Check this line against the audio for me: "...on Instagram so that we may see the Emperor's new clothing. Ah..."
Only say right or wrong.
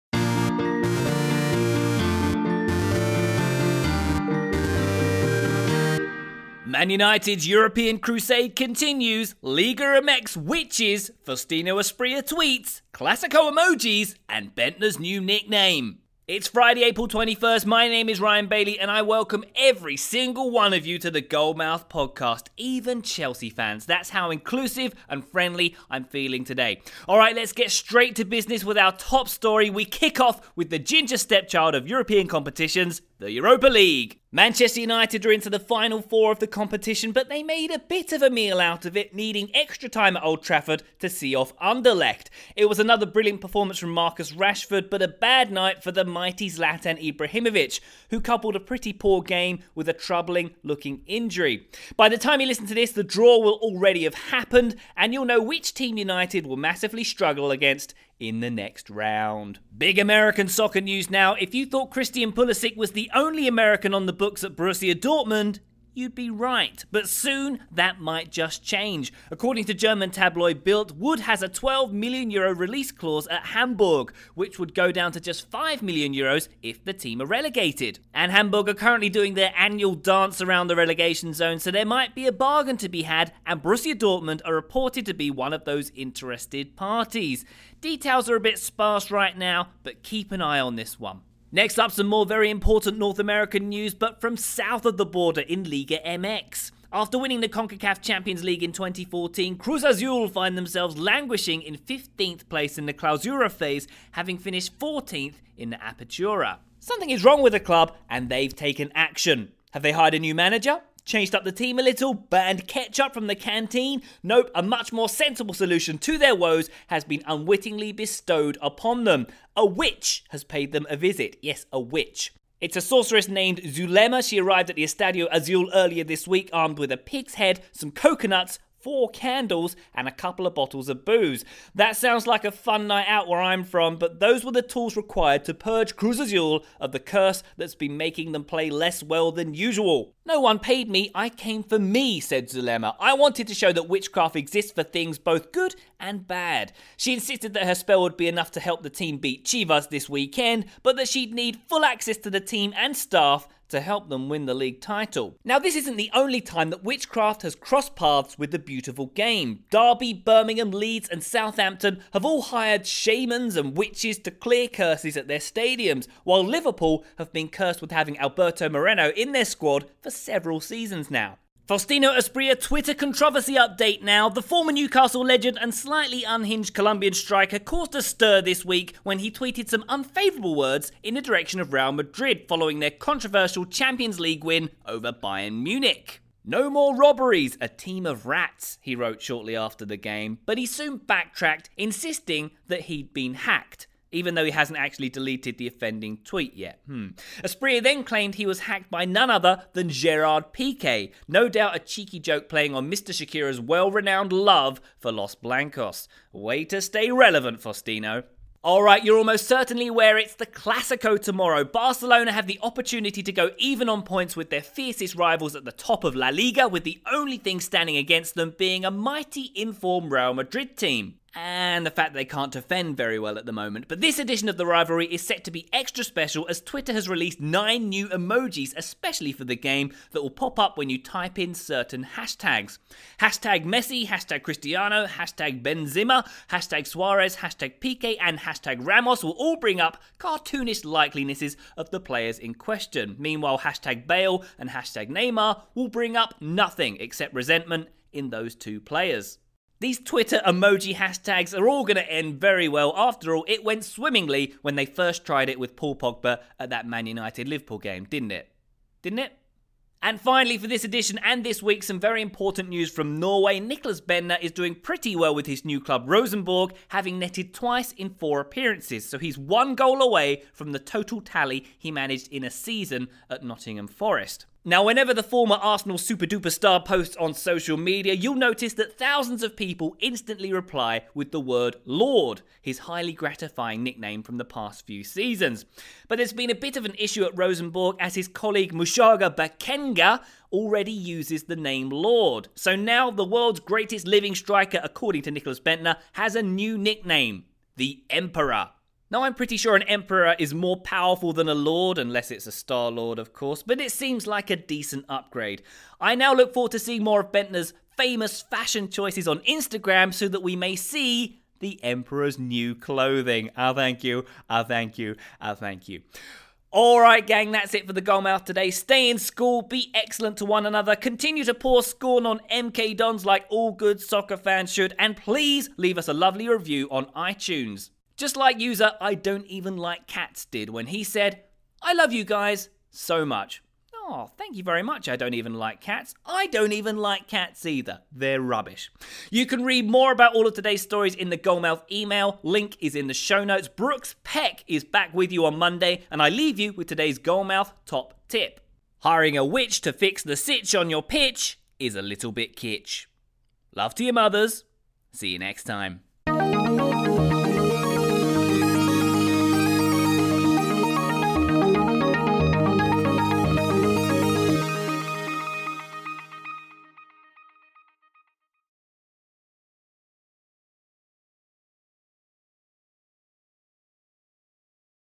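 right.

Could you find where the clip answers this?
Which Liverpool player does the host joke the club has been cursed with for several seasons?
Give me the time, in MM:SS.
02:48.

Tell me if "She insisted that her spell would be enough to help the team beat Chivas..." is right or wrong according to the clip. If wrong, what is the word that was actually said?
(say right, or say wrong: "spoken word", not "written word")
right.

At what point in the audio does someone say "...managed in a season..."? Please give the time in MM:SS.
04:31.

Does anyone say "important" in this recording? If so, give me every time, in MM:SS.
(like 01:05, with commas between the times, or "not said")
01:32, 04:22.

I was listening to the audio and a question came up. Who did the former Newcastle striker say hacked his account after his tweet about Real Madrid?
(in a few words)
Gerard Piqué.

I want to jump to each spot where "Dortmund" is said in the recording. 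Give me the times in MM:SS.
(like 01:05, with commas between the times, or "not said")
01:04, 01:23.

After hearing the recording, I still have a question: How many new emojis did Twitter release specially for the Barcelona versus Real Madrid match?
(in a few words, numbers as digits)
9.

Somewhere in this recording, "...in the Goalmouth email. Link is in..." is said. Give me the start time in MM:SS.
05:41.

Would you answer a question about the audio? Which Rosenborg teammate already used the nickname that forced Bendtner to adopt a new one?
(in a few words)
Mushaga Bakenga.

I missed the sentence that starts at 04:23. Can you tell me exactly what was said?
Nicklas Bendtner is doing pretty well with his new club Rosenborg, having netted twice in four appearances.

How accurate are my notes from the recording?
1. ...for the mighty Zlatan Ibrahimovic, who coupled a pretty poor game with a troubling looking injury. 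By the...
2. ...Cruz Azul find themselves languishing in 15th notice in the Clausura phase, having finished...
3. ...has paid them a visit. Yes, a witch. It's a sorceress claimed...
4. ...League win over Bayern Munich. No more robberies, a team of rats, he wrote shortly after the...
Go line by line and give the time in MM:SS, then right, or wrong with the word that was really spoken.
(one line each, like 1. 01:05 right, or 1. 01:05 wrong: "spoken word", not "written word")
1. 00:45 right
2. 01:39 wrong: "place", not "notice"
3. 02:00 wrong: "named", not "claimed"
4. 03:04 right.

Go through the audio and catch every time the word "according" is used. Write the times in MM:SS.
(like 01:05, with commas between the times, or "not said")
01:09, 04:54.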